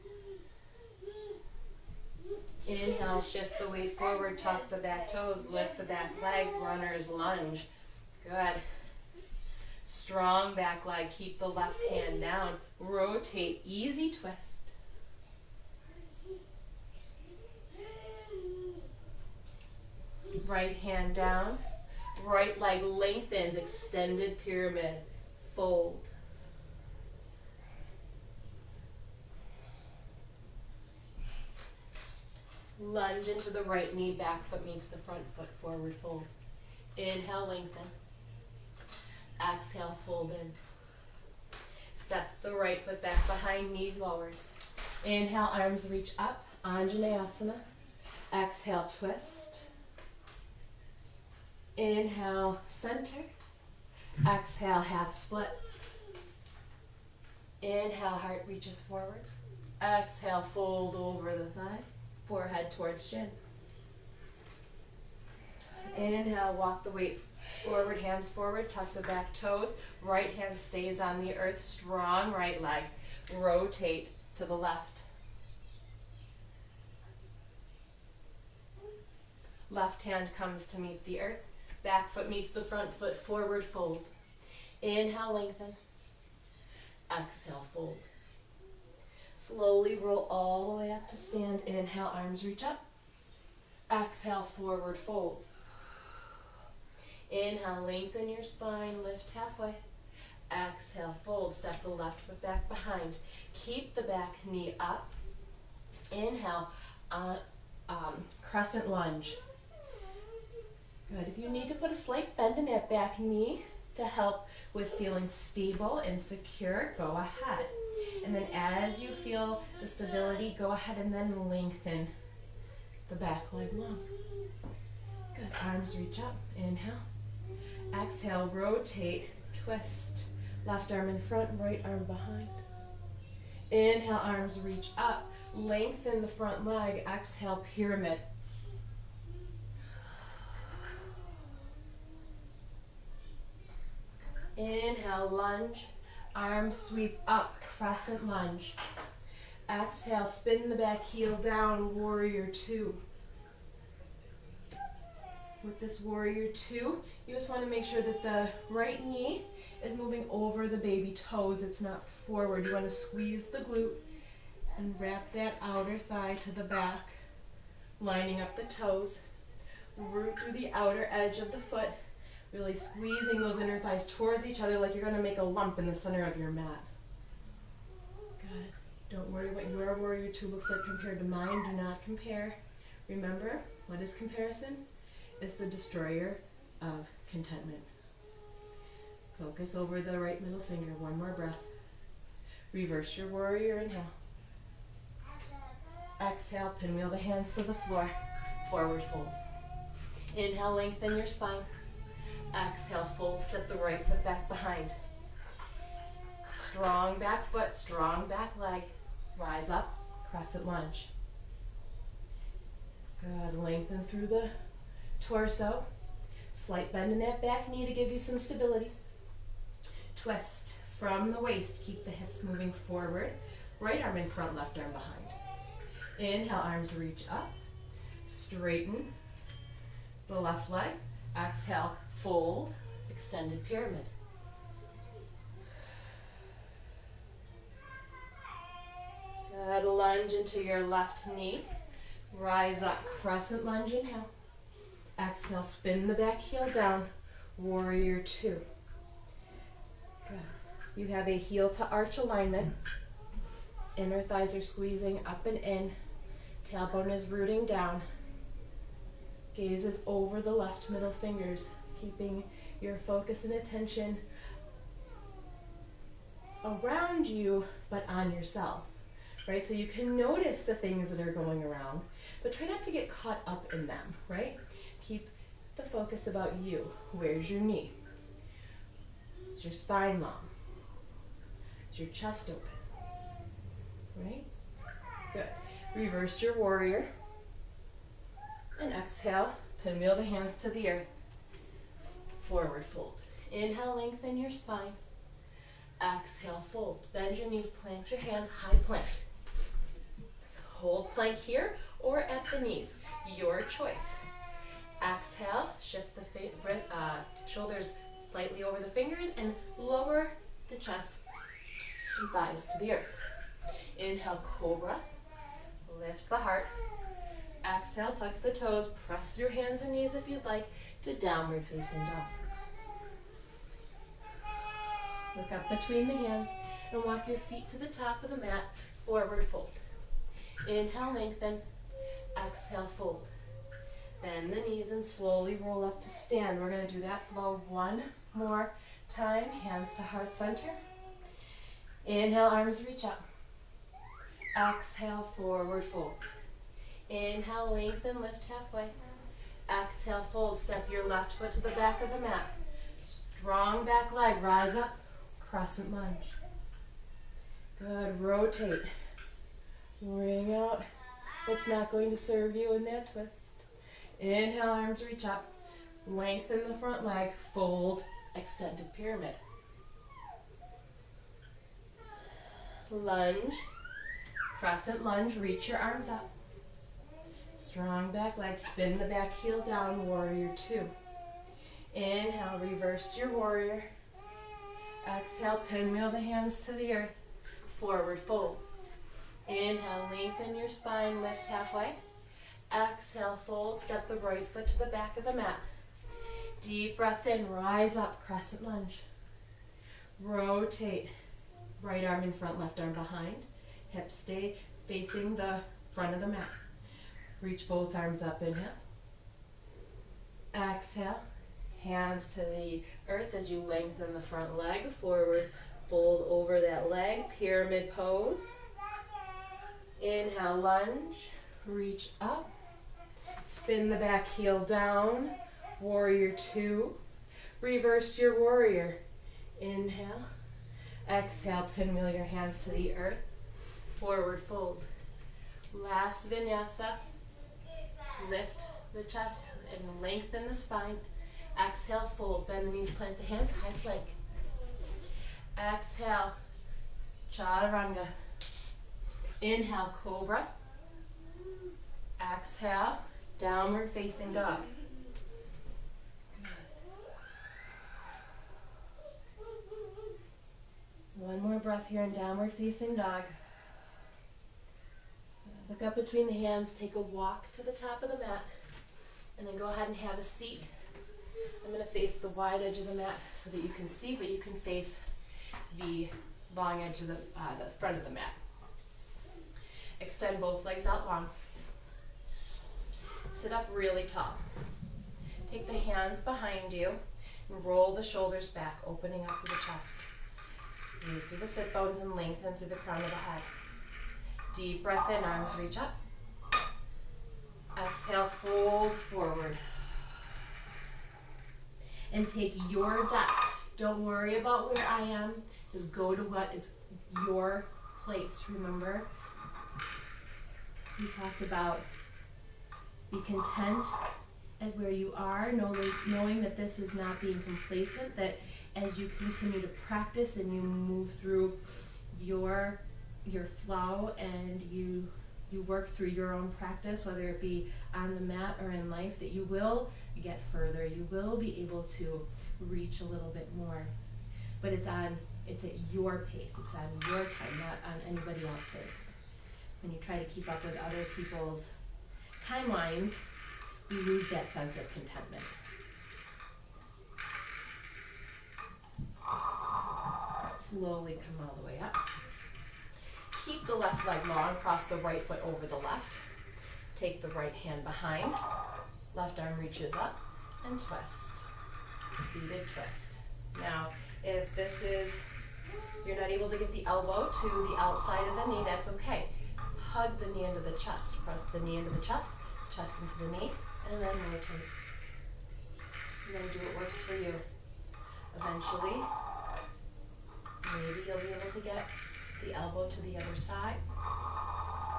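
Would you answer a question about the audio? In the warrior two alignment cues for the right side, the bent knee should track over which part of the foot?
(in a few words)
the baby toes.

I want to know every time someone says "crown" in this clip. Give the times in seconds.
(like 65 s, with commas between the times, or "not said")
492 s.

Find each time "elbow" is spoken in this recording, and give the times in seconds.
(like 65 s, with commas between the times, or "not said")
566 s, 582 s.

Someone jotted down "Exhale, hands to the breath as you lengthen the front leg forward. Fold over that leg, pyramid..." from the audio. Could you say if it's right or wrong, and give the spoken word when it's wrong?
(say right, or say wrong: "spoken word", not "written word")
wrong: "earth", not "breath".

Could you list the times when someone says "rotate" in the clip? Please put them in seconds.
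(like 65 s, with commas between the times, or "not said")
12 s, 73 s, 128 s, 358 s, 400 s, 574 s.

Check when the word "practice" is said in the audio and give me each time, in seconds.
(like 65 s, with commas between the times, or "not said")
519 s, 526 s.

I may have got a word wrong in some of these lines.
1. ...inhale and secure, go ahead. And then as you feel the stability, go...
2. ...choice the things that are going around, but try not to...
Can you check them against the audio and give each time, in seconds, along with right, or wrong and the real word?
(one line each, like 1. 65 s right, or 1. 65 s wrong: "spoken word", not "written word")
1. 115 s wrong: "stable", not "inhale"
2. 270 s wrong: "notice", not "choice".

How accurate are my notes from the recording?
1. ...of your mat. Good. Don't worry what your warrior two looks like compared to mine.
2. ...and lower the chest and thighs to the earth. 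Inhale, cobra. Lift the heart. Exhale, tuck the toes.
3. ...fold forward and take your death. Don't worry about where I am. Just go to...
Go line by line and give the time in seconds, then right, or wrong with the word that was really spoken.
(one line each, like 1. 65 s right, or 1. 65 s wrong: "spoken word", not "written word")
1. 176 s right
2. 309 s right
3. 498 s right.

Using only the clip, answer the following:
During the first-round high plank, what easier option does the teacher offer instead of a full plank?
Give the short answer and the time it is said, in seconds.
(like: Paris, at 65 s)
at the knees, at 302 s.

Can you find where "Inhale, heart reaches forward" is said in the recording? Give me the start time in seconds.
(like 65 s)
57 s.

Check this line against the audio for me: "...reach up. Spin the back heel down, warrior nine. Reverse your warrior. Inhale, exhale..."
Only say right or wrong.
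wrong.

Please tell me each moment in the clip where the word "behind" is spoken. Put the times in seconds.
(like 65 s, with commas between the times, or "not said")
43 s, 102 s, 132 s, 204 s, 224 s, 402 s, 486 s, 557 s.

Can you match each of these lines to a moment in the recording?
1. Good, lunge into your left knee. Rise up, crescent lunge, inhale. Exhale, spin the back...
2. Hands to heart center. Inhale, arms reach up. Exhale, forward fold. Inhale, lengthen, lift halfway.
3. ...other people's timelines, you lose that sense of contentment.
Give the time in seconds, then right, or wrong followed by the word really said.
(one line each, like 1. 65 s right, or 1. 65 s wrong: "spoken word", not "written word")
1. 239 s right
2. 339 s right
3. 540 s right.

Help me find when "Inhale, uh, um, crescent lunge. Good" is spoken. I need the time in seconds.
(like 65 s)
106 s.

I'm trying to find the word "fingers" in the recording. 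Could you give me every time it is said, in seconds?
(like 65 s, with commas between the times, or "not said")
190 s, 261 s, 308 s.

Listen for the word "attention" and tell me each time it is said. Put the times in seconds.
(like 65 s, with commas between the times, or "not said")
263 s.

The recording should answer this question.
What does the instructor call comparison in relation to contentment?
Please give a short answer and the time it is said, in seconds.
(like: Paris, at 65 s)
the destroyer, at 185 s.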